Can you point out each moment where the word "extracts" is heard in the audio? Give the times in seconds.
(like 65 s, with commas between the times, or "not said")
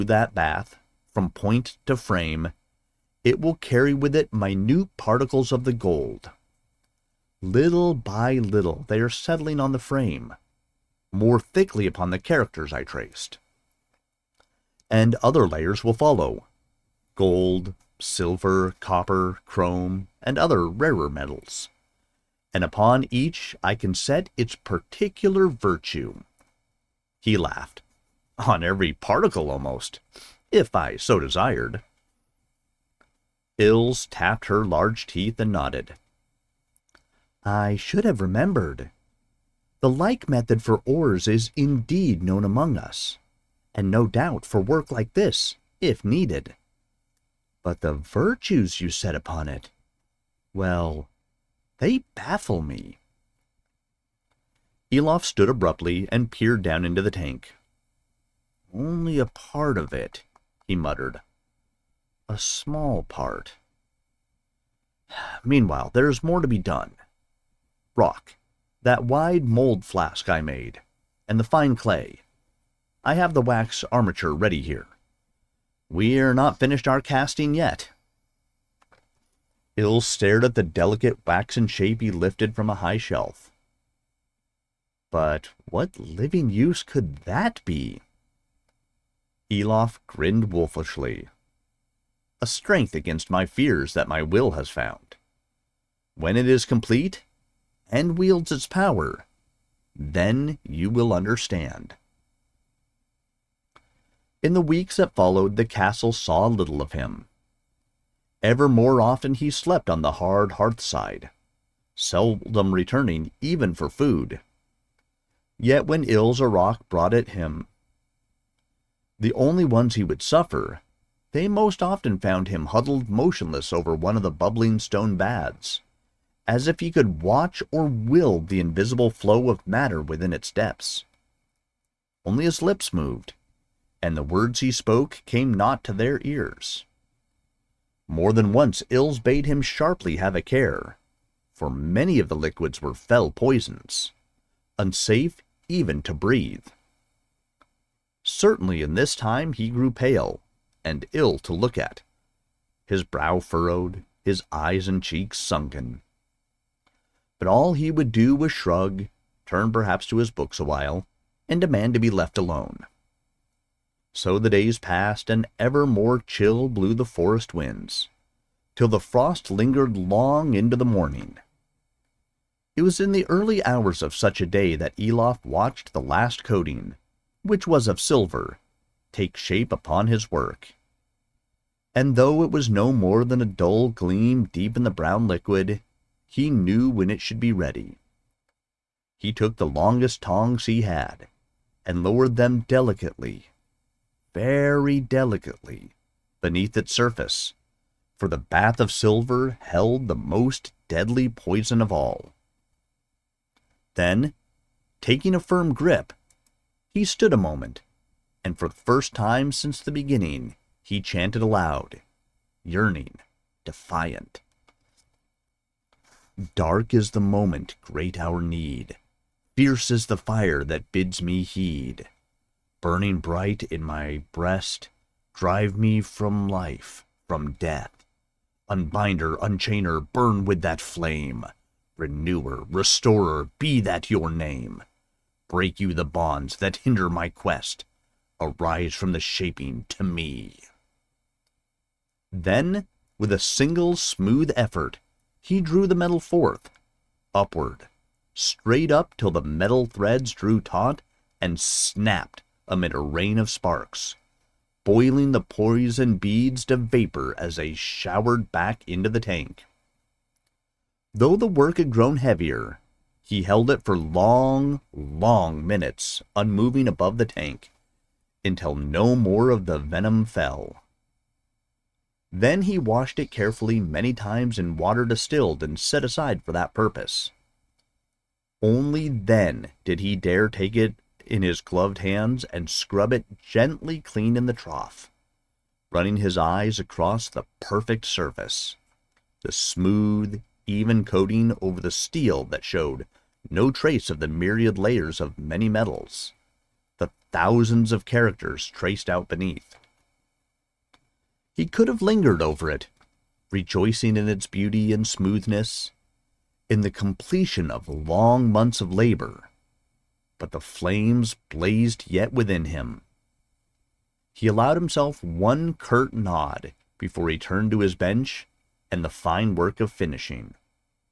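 not said.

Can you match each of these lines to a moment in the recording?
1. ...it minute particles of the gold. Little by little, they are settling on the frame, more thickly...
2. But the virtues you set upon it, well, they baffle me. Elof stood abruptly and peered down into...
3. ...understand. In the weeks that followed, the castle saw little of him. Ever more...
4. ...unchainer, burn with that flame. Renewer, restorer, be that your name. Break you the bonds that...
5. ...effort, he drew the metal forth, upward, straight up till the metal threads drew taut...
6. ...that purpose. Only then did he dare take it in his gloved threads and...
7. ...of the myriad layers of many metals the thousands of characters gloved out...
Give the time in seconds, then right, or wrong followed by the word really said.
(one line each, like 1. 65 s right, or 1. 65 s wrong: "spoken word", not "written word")
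1. 4 s right
2. 47 s right
3. 101 s right
4. 229 s right
5. 244 s right
6. 276 s wrong: "hands", not "threads"
7. 294 s wrong: "traced", not "gloved".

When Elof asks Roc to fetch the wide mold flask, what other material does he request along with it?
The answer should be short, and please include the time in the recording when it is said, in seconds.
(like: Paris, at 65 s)
Fine clay, at 71 s.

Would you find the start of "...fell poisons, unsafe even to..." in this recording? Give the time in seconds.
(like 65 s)
142 s.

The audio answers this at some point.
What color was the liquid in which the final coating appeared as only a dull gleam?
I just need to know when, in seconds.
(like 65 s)
184 s.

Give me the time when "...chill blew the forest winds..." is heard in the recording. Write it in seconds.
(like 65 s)
166 s.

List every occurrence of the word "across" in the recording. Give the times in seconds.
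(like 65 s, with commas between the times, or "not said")
286 s.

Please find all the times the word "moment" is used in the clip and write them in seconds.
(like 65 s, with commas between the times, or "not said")
207 s, 217 s.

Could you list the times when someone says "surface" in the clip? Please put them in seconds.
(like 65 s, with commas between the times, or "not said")
196 s, 288 s.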